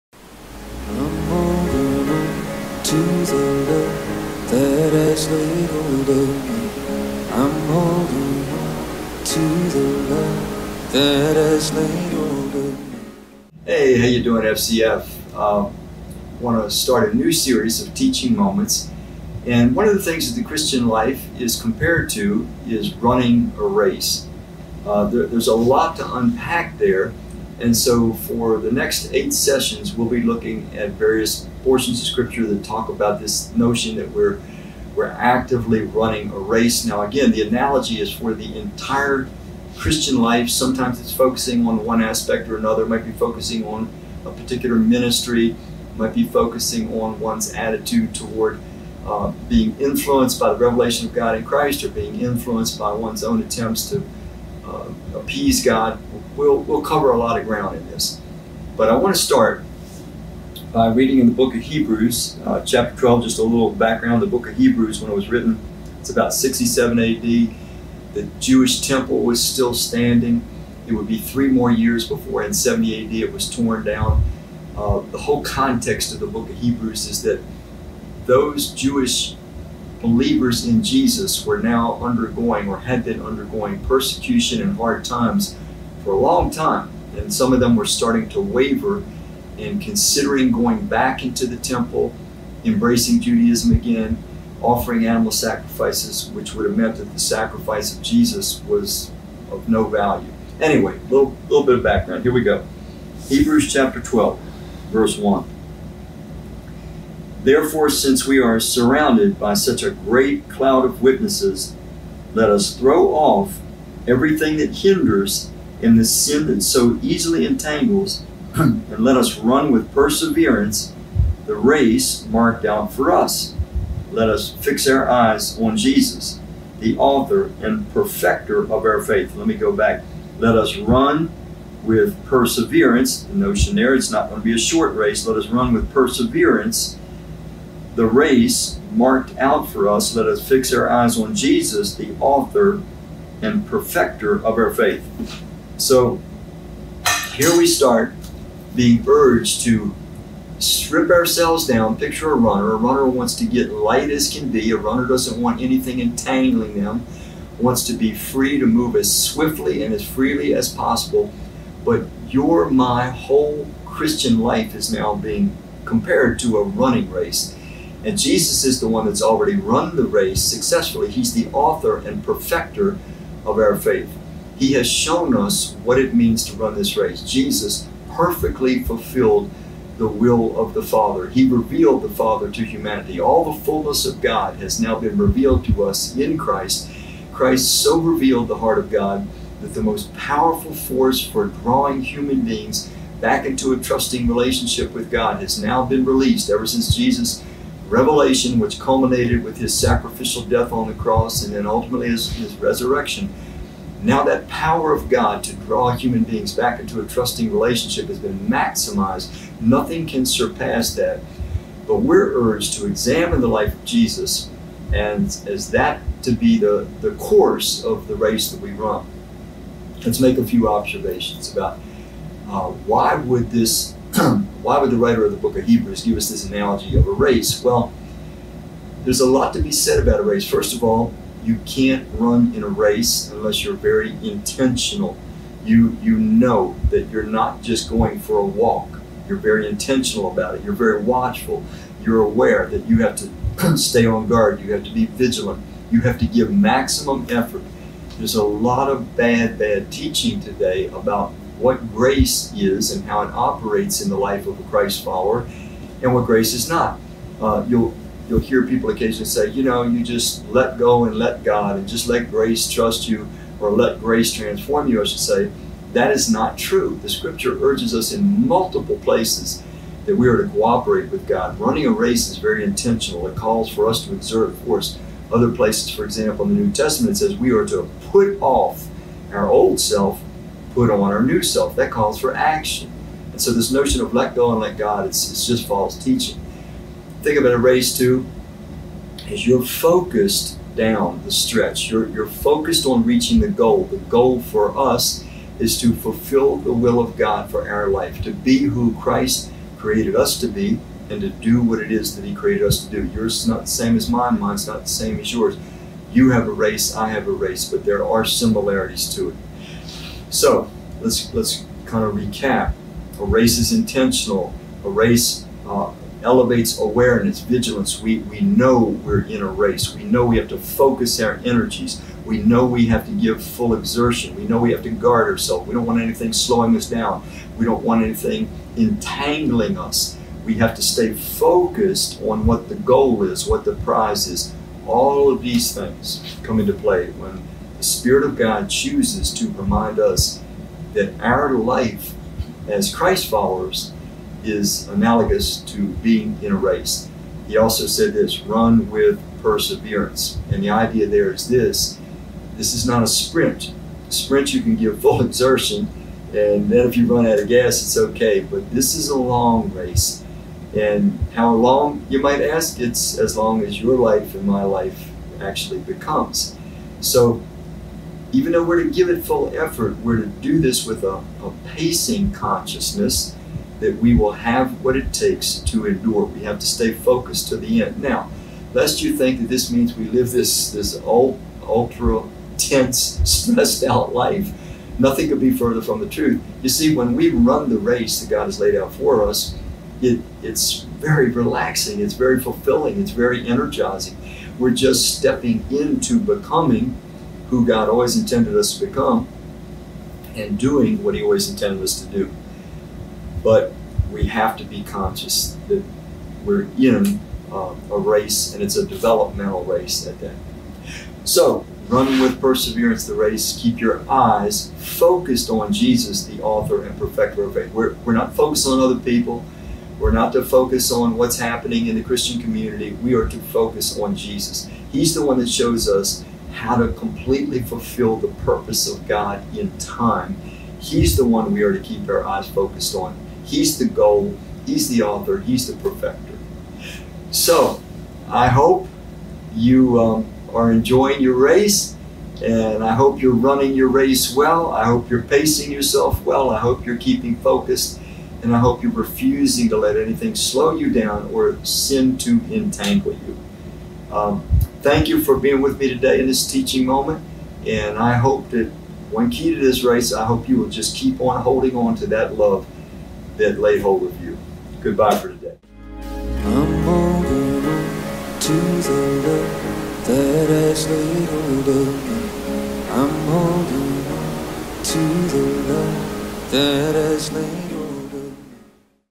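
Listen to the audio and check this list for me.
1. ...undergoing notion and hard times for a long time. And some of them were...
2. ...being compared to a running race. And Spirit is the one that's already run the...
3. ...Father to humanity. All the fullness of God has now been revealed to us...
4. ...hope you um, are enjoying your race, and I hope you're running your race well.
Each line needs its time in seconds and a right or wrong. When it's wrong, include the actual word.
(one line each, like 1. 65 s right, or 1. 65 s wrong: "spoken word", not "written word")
1. 83 s wrong: "persecution", not "notion"
2. 165 s wrong: "Jesus", not "Spirit"
3. 182 s right
4. 438 s right.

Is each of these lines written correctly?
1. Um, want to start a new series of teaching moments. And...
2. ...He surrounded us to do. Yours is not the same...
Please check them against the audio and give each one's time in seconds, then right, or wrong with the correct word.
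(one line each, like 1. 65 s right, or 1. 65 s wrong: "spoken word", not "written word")
1. 15 s right
2. 302 s wrong: "created", not "surrounded".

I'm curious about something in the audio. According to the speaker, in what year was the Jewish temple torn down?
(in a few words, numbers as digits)
70 AD.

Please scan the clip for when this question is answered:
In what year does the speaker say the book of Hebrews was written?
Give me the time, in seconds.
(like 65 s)
66 s.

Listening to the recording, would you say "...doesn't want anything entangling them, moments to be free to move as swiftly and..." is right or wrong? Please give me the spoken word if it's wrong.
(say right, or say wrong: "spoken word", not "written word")
wrong: "wants", not "moments".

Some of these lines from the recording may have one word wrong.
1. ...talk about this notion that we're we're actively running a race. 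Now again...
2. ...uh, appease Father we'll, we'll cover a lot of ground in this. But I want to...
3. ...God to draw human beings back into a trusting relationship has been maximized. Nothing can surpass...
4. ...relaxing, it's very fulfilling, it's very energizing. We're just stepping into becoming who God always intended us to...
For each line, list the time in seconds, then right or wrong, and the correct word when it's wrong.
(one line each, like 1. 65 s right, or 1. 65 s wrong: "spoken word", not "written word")
1. 32 s right
2. 54 s wrong: "God", not "Father"
3. 205 s right
4. 391 s right.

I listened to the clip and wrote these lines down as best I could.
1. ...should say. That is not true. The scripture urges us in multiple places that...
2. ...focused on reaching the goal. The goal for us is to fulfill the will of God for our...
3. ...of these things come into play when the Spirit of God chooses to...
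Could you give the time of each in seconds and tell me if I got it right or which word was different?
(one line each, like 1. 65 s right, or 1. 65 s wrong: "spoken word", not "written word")
1. 265 s right
2. 292 s right
3. 335 s right.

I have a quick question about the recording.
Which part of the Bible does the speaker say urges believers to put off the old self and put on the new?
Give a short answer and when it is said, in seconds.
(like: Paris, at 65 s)
New Testament, at 276 s.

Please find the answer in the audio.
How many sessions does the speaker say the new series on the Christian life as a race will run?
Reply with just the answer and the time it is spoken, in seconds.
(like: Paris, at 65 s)
8, at 29 s.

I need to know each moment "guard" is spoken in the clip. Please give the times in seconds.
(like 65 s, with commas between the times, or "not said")
244 s, 324 s.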